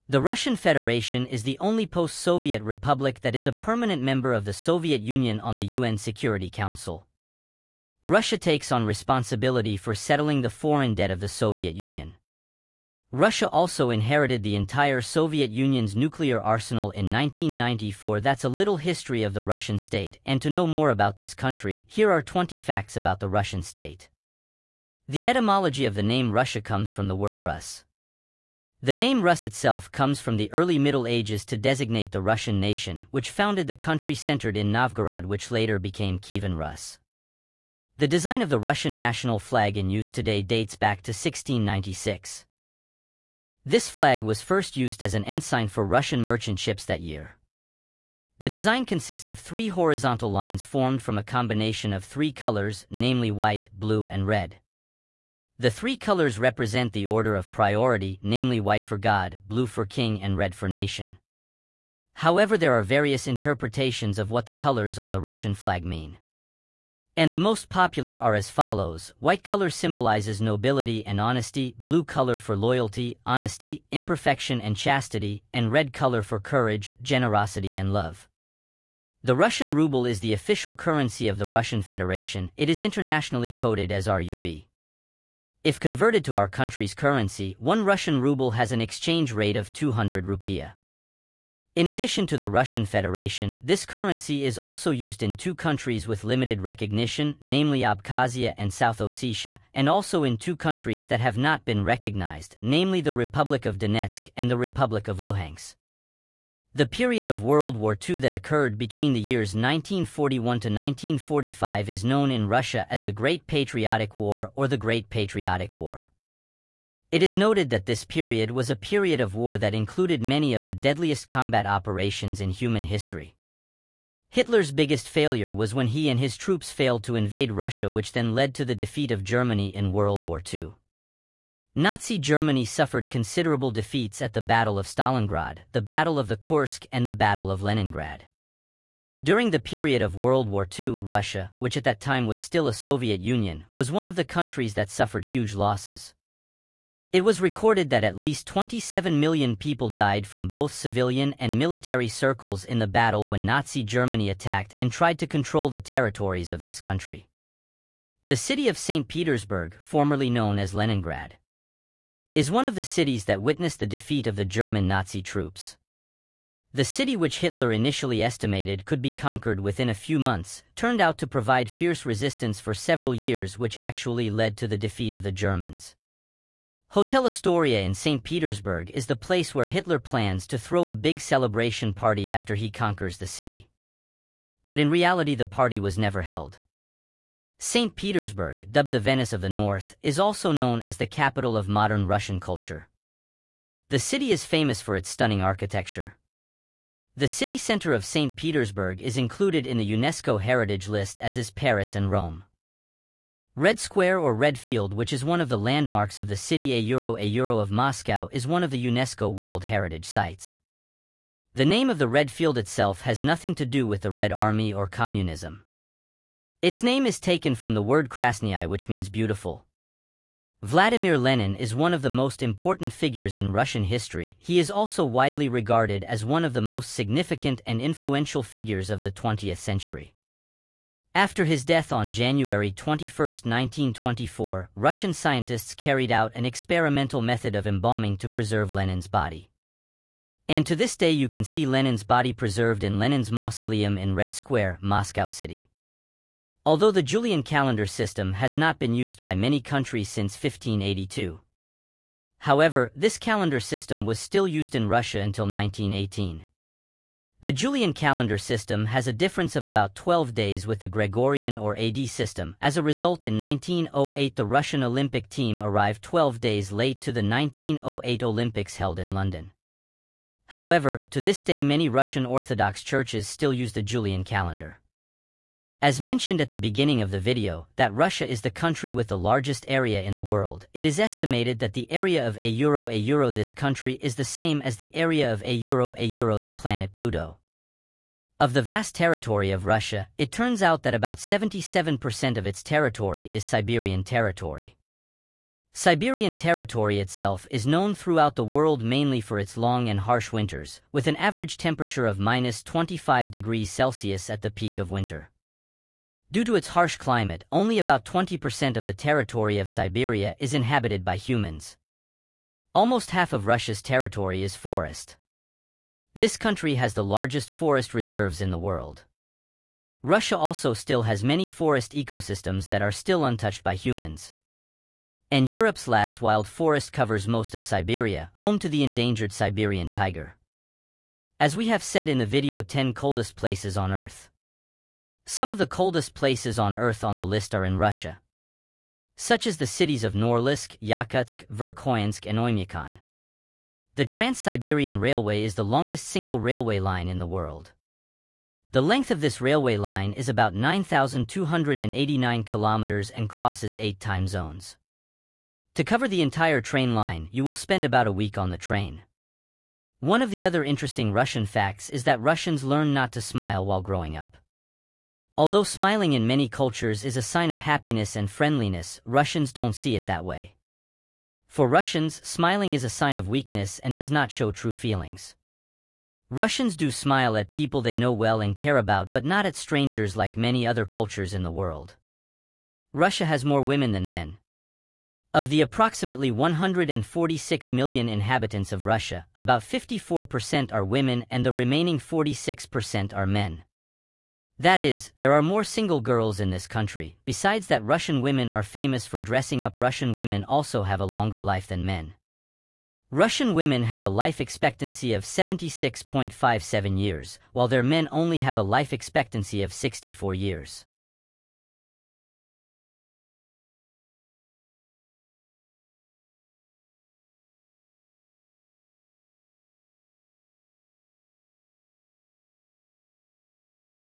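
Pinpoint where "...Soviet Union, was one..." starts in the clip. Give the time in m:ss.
2:22.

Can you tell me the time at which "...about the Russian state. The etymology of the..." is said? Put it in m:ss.
0:22.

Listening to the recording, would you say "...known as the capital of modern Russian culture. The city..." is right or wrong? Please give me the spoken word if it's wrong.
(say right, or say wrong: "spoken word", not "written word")
right.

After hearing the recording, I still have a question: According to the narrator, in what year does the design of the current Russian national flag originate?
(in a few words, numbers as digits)
1696.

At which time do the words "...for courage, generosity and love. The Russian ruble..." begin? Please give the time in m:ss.
1:16.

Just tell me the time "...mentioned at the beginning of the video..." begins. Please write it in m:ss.
4:36.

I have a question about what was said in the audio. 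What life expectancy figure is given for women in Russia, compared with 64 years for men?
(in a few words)
76.57 years.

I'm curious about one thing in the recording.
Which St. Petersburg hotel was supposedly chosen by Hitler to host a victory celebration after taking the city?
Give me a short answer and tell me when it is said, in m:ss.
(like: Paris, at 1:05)
Hotel Astoria, at 2:56.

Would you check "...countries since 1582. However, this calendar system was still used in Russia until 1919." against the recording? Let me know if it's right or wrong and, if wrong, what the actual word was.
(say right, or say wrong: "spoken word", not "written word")
wrong: "1918", not "1919".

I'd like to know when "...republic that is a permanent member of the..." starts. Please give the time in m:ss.
0:02.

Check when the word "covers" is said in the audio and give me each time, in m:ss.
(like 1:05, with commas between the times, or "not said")
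5:26, 5:55.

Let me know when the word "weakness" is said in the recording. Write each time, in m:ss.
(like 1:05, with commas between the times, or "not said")
6:13.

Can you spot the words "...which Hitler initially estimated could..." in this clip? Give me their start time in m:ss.
2:47.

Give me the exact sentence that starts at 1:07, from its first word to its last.
And the most popular are as follows.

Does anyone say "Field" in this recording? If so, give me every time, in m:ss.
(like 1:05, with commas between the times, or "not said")
3:24, 3:32.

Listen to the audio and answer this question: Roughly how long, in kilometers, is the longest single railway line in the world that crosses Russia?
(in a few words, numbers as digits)
9,289 kilometers.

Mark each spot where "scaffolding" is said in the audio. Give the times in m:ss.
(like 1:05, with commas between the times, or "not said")
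not said.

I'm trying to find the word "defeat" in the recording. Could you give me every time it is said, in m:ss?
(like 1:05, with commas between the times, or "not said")
2:08, 2:13, 2:43, 2:54.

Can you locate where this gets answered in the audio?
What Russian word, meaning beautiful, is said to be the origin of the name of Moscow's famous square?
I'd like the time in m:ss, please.
3:38.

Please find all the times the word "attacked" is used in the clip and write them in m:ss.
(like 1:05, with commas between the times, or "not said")
2:34.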